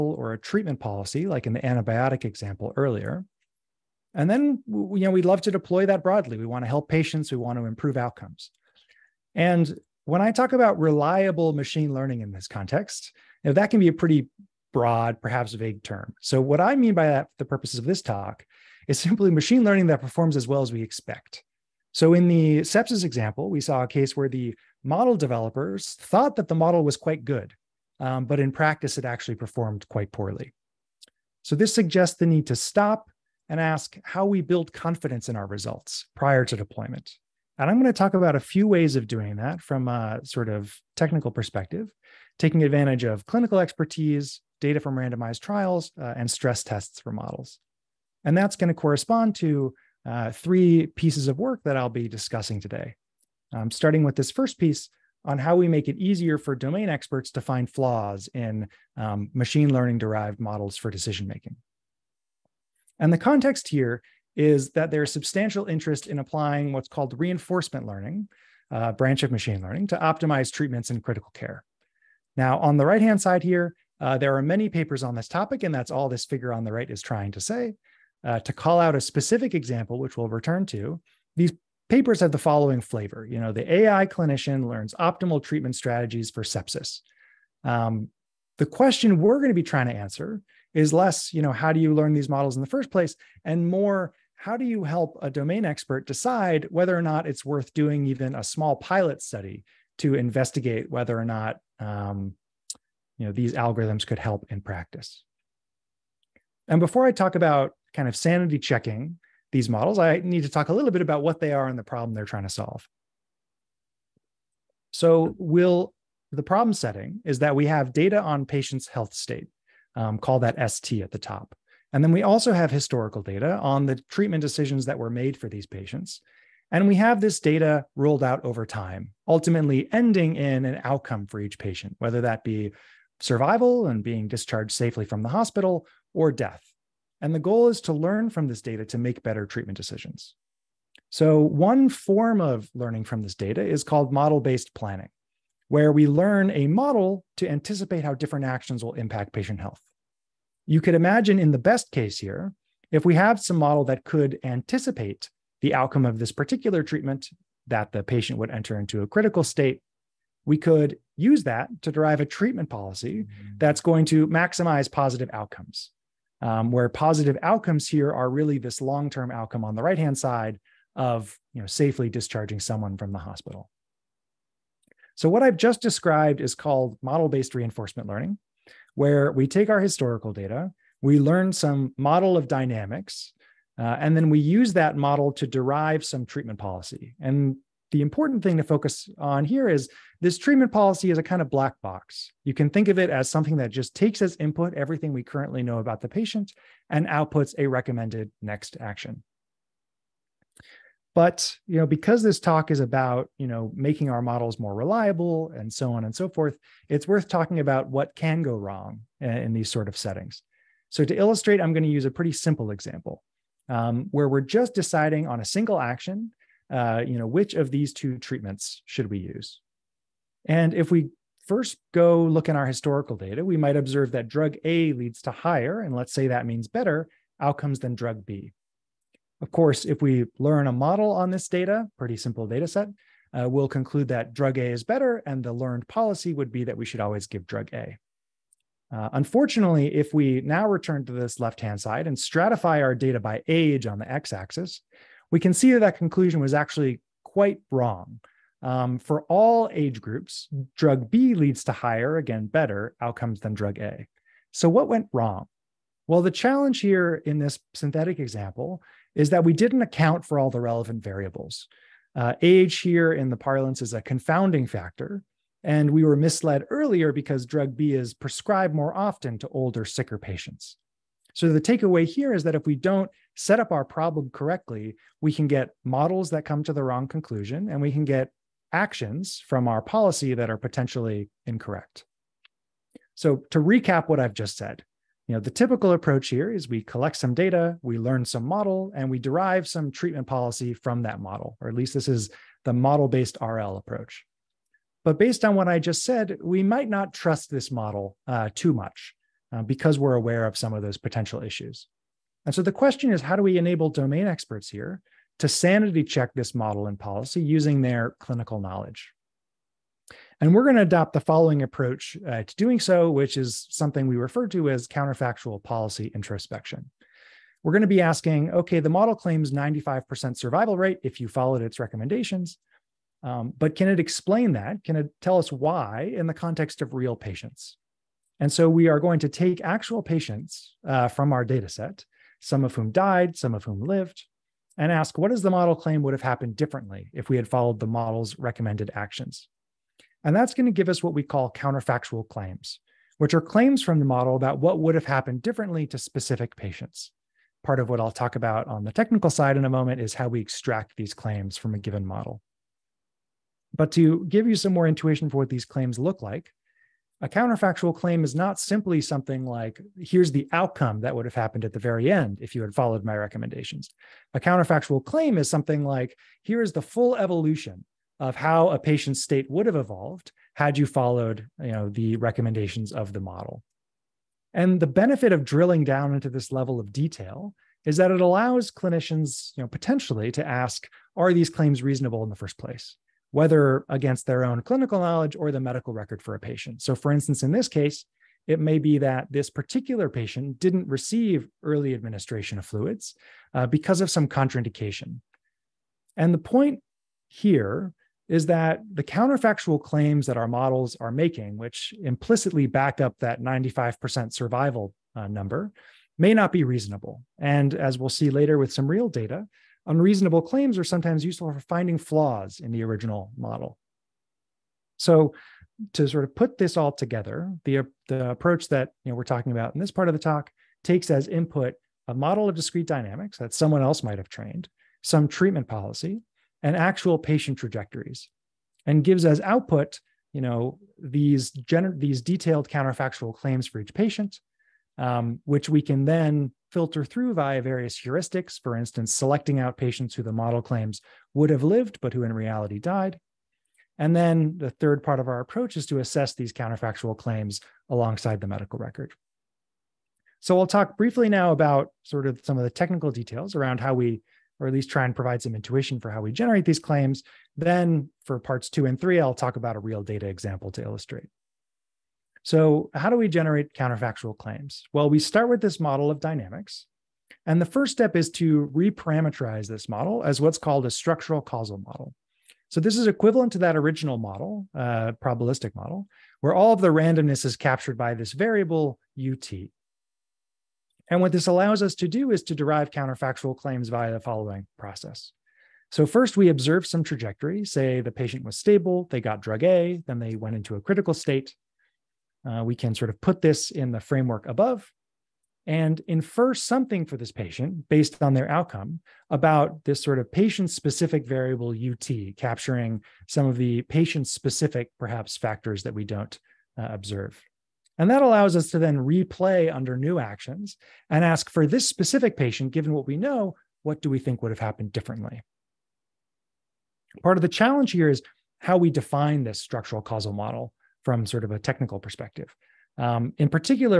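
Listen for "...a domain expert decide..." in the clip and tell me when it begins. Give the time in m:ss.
1:35.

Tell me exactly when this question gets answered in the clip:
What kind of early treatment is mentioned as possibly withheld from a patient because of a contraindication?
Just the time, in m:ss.
6:32.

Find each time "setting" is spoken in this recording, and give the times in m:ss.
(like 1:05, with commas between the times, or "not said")
1:56, 3:29.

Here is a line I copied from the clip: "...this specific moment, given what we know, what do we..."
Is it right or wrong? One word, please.
wrong.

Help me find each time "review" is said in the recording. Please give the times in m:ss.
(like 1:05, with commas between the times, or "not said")
not said.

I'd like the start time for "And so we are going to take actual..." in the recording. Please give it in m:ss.
5:28.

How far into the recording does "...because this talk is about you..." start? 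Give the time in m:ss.
3:21.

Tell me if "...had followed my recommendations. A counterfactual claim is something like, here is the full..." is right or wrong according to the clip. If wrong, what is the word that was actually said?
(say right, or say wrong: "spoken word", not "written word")
right.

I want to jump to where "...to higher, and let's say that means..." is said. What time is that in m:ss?
3:45.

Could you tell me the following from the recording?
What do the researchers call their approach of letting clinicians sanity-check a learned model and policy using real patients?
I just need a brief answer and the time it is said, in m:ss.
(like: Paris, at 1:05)
counterfactual policy introspection, at 5:14.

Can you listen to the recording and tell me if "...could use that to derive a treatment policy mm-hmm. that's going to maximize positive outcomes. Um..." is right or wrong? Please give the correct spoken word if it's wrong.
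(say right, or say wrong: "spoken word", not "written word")
right.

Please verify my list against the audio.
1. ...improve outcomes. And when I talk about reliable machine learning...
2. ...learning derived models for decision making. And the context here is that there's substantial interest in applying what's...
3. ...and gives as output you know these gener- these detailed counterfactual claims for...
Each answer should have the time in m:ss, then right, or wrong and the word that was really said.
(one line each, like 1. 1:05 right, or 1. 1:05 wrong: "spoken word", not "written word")
1. 0:07 right
2. 0:59 right
3. 7:08 right.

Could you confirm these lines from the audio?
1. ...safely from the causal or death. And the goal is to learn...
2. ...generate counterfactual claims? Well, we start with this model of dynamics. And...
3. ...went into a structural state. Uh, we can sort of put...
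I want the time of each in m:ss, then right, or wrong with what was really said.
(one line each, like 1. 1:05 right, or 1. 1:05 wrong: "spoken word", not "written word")
1. 2:14 wrong: "hospital", not "causal"
2. 7:43 right
3. 8:10 wrong: "critical", not "structural".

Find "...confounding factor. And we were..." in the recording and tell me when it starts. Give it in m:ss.
4:24.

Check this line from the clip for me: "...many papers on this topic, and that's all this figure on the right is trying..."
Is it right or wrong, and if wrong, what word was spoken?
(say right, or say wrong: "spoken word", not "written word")
right.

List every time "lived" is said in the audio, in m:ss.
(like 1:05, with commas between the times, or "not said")
5:33, 7:21.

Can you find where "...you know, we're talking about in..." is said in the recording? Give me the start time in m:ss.
6:59.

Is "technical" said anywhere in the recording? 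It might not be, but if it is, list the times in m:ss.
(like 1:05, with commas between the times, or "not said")
0:40, 5:48, 7:32, 8:41.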